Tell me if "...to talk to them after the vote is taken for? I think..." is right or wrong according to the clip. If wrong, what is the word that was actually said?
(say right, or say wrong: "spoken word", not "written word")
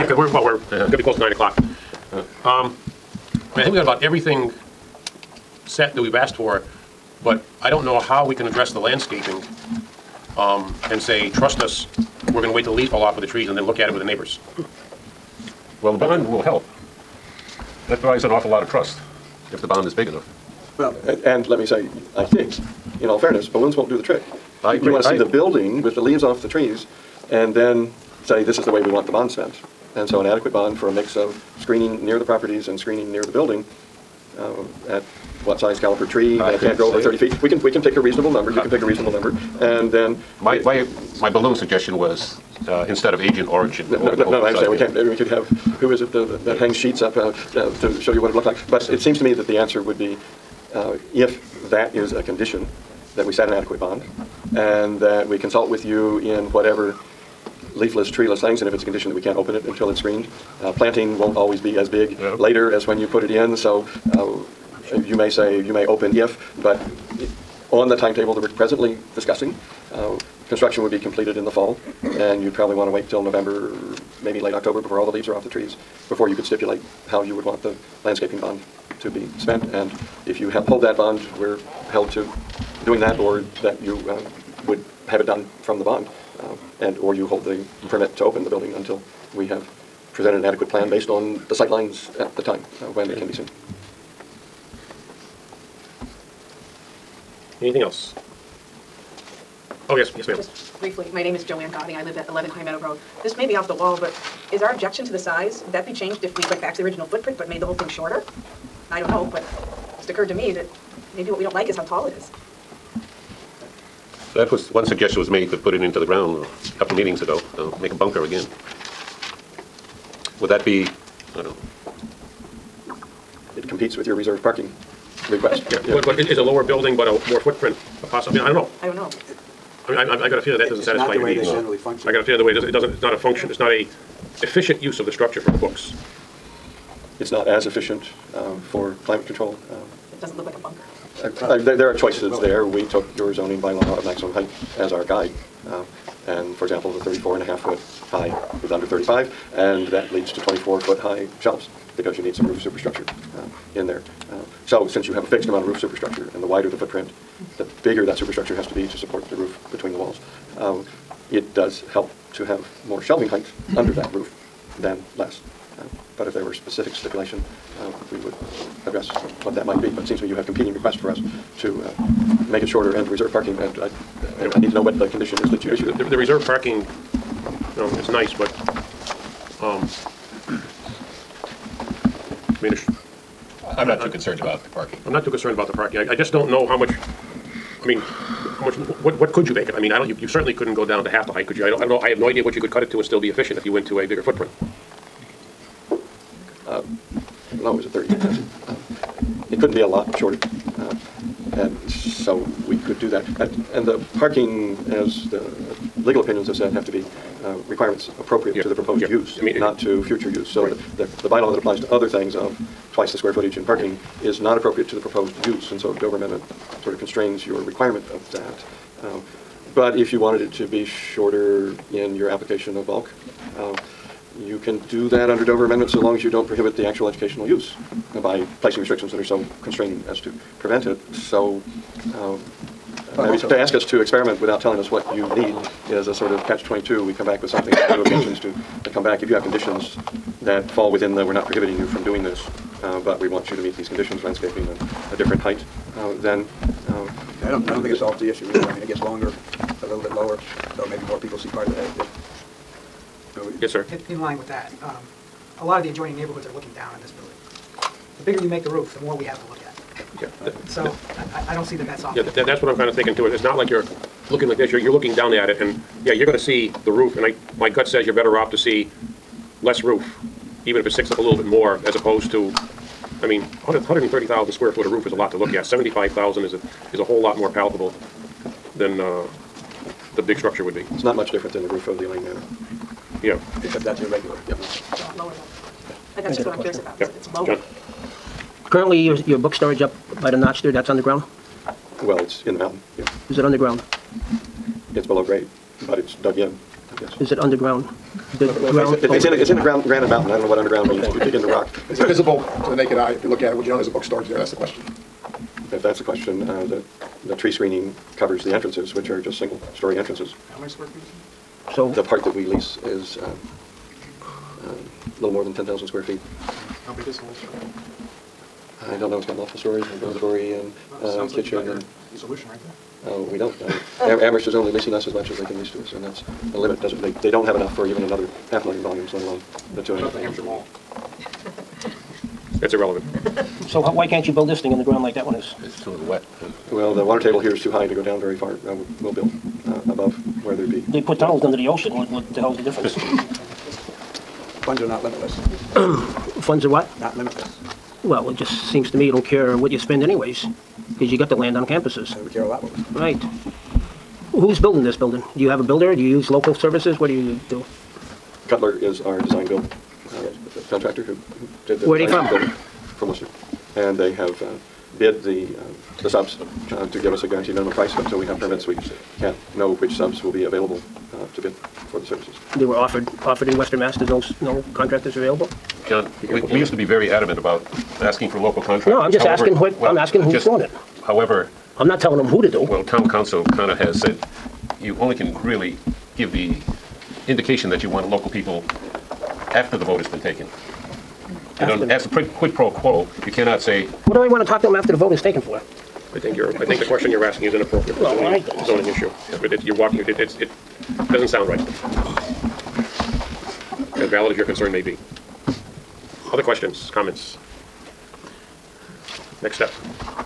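right.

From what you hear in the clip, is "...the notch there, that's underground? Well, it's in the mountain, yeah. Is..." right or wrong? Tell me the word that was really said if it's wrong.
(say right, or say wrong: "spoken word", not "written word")
right.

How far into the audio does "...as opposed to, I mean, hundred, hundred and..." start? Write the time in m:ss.
4:31.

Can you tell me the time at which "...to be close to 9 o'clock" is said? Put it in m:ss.
0:00.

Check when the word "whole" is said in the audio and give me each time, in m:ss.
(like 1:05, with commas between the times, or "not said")
1:47, 4:37, 5:17.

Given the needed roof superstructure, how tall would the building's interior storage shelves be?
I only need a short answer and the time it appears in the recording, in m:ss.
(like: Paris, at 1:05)
24 feet, at 2:30.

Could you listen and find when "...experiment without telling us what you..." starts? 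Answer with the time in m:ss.
3:54.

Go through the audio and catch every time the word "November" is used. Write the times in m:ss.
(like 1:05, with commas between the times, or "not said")
1:13.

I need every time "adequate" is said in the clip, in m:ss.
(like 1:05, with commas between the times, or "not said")
0:30, 0:53, 1:30.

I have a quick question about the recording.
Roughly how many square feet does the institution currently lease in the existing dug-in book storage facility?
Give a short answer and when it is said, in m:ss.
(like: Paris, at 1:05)
10,000, at 5:15.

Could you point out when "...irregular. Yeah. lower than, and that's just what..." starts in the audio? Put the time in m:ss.
4:43.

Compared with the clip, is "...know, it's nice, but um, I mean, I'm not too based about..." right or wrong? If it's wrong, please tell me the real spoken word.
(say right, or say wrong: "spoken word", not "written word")
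wrong: "concerned", not "based".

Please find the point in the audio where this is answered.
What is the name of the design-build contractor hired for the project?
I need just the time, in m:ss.
5:58.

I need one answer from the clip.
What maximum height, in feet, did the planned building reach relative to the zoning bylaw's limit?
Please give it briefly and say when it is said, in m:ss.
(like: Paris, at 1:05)
34.5, at 2:27.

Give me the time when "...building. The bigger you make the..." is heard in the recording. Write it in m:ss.
4:17.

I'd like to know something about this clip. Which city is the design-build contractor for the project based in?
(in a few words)
Worcester.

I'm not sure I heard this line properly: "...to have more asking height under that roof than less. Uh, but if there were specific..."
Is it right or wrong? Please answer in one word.
wrong.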